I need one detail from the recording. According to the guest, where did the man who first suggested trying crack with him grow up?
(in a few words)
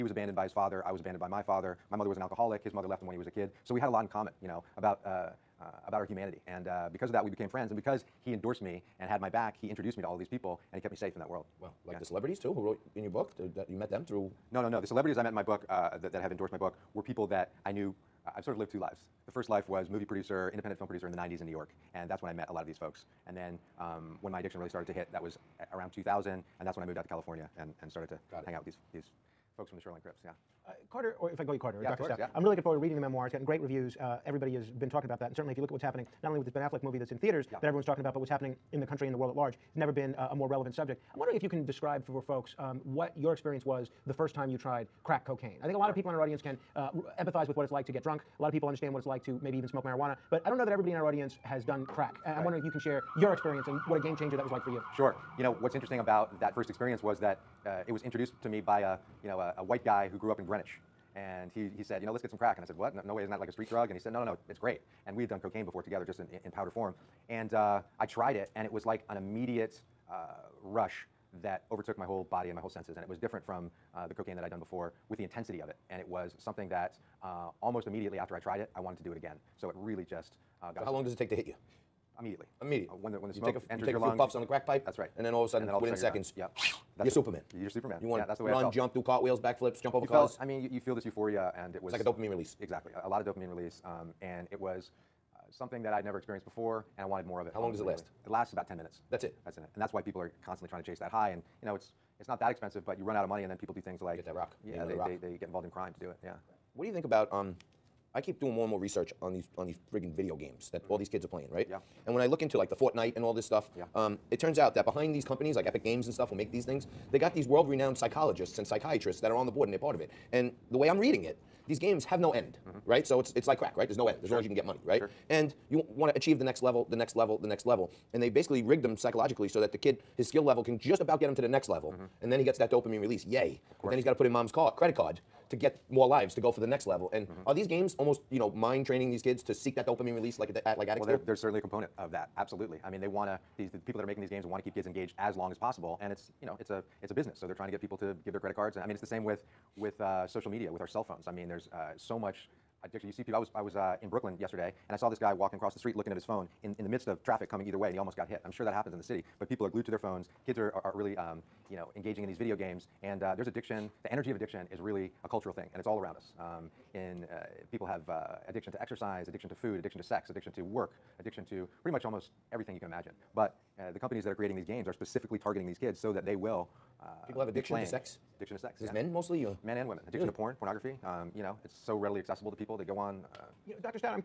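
Greenwich.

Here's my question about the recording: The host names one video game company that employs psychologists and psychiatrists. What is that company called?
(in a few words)
Epic Games.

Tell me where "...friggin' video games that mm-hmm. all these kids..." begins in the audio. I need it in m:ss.
1:49.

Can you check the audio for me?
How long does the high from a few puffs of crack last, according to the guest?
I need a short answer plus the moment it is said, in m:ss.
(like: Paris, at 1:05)
10 minutes, at 1:38.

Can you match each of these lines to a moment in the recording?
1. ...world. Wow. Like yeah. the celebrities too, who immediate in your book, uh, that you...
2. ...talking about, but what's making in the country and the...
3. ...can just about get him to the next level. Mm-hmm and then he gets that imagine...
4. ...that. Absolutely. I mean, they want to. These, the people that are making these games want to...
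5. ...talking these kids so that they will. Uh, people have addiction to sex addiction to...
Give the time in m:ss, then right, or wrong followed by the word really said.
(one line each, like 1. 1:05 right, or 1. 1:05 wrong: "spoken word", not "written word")
1. 0:11 wrong: "wrote", not "immediate"
2. 0:37 wrong: "happening", not "making"
3. 2:10 wrong: "dopamine", not "imagine"
4. 2:22 right
5. 2:55 wrong: "targeting", not "talking".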